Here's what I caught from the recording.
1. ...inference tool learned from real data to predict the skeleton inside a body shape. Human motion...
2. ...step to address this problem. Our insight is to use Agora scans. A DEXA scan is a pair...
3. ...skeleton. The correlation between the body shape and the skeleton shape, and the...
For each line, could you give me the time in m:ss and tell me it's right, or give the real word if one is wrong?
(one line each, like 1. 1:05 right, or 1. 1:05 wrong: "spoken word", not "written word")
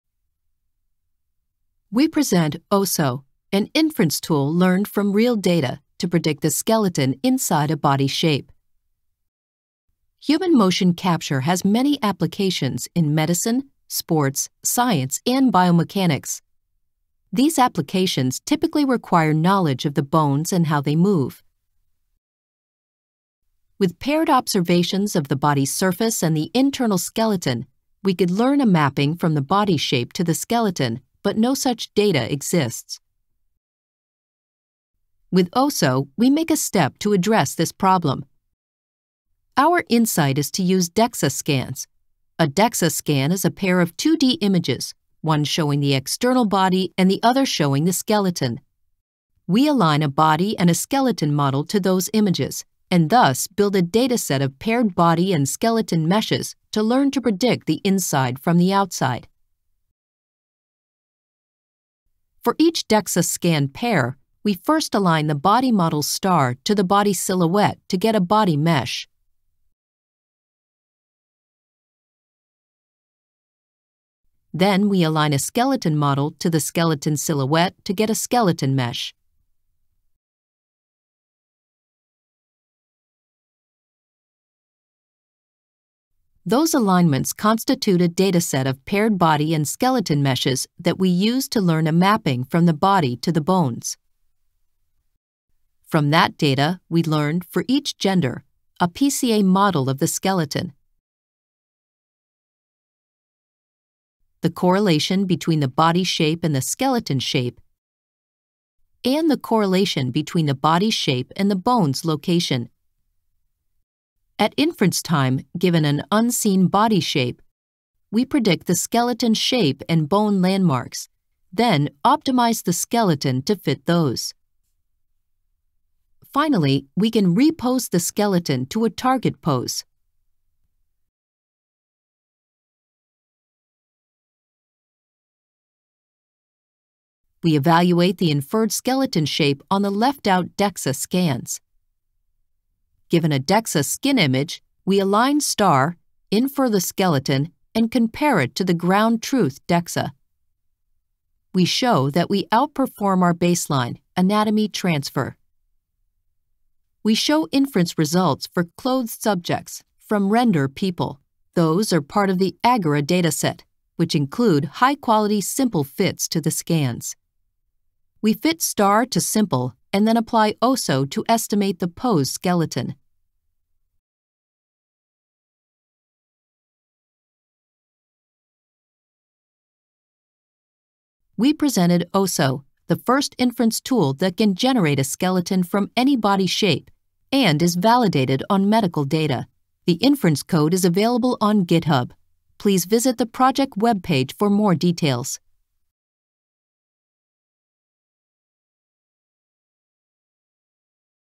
1. 0:03 right
2. 0:36 wrong: "DEXA", not "Agora"
3. 1:40 right.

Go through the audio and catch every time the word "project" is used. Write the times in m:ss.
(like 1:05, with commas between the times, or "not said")
3:13.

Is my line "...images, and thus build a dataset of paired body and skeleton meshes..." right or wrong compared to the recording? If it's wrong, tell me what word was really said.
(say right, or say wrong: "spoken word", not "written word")
right.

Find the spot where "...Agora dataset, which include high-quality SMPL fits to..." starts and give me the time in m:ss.
2:42.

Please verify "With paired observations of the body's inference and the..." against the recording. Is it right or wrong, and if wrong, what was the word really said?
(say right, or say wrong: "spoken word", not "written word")
wrong: "surface", not "inference".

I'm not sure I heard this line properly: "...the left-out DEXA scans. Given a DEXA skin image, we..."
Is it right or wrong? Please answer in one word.
right.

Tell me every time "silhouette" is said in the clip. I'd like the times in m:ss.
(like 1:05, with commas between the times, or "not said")
1:07, 1:17.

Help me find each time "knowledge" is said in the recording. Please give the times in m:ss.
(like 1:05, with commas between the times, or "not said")
0:19.